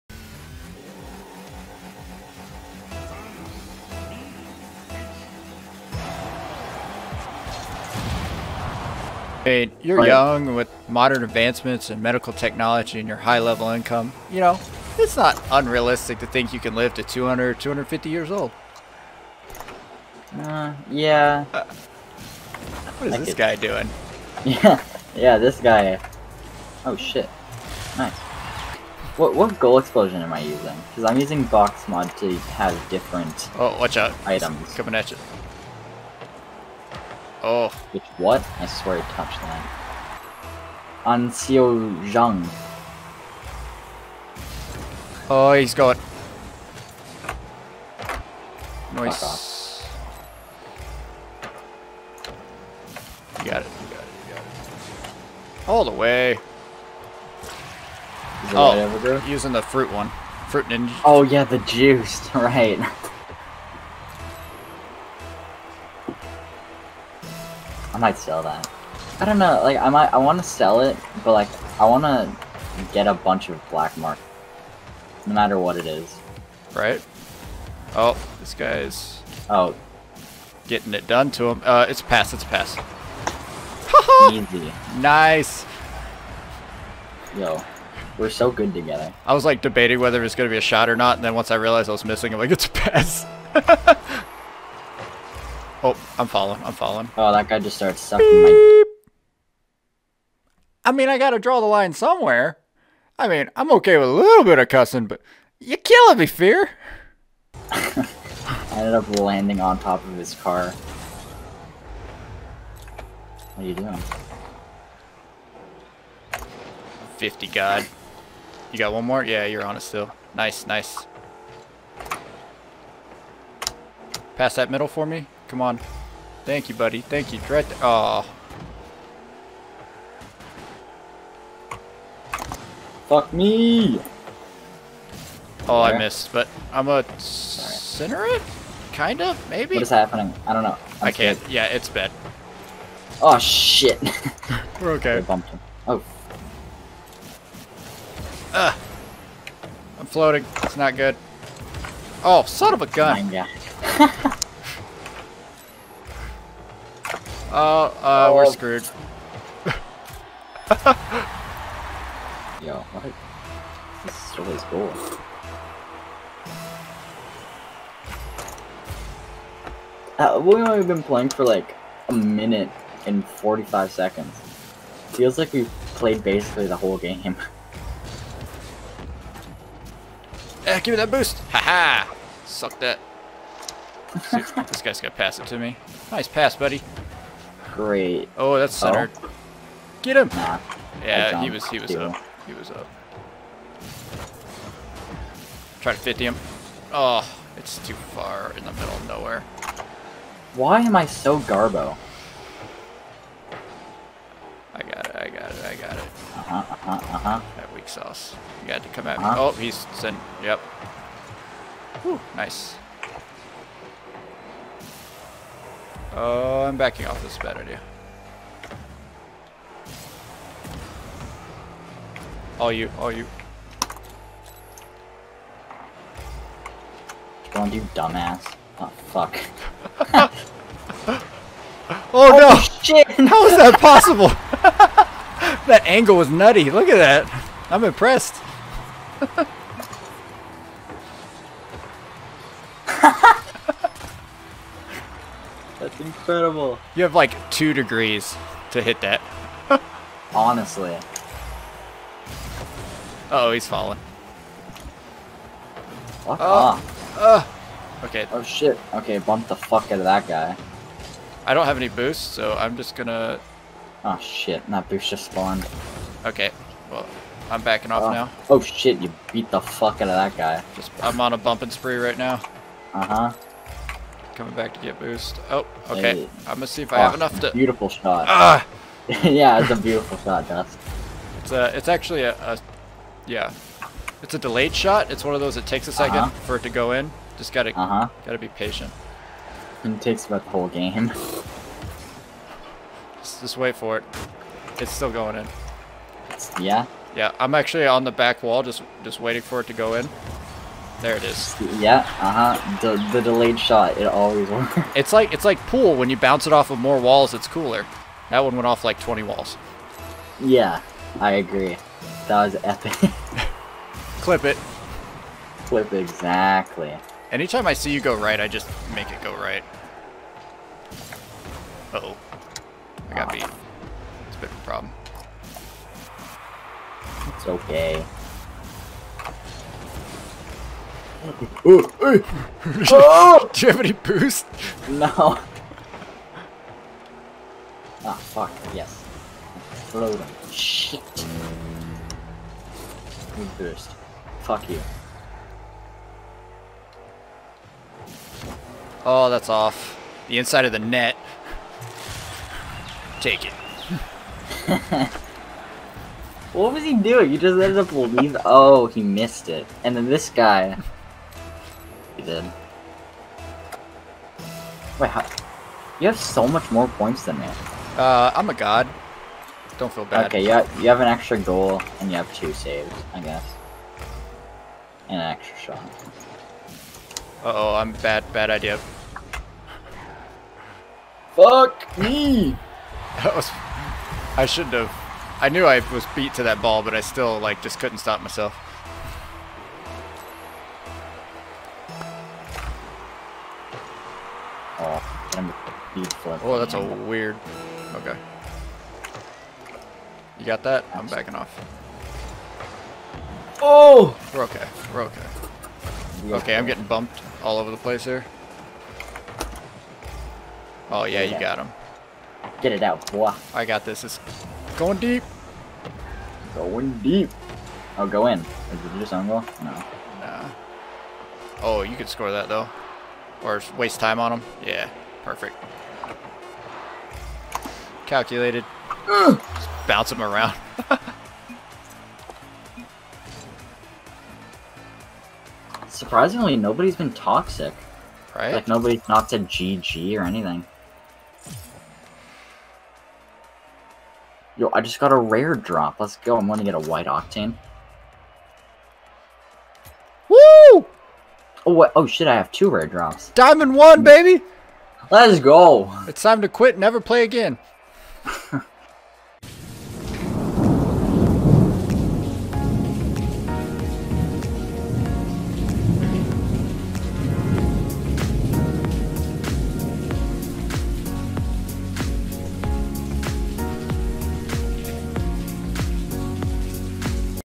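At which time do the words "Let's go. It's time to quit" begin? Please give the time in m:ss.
7:35.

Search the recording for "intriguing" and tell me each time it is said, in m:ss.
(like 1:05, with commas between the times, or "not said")
not said.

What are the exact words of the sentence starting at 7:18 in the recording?
Like, nobody's not said GG or anything.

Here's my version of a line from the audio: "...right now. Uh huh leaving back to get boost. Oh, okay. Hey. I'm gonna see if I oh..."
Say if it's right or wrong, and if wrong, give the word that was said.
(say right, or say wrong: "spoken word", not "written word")
wrong: "coming", not "leaving".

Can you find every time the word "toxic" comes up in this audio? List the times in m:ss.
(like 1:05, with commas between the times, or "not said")
7:17.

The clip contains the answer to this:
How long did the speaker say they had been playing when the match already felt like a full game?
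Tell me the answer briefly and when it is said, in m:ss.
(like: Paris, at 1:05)
a minute and 45 seconds, at 2:52.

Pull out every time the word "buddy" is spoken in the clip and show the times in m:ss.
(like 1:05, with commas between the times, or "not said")
2:06, 3:06.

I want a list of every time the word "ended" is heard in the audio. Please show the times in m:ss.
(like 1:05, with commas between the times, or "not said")
1:48, 5:57.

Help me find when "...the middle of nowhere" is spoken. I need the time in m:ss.
3:18.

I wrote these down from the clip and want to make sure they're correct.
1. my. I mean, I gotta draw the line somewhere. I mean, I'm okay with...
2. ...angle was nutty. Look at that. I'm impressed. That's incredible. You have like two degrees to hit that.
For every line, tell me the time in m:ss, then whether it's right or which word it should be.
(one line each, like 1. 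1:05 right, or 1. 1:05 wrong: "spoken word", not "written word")
1. 1:38 right
2. 3:55 right.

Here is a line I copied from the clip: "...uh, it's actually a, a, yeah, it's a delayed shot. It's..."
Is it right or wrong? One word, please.
right.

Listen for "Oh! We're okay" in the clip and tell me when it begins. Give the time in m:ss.
6:43.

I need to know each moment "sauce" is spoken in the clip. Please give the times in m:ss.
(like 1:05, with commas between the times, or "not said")
3:27.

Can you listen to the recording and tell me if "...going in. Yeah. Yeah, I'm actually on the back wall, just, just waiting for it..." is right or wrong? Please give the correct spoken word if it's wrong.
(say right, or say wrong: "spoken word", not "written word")
right.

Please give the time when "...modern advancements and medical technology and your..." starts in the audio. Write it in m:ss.
0:10.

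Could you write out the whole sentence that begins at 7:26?
I'm going to get a white octane.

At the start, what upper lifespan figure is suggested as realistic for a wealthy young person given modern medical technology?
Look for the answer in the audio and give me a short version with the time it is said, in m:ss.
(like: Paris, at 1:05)
250 years, at 0:17.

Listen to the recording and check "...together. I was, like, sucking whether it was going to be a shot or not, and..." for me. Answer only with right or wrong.
wrong.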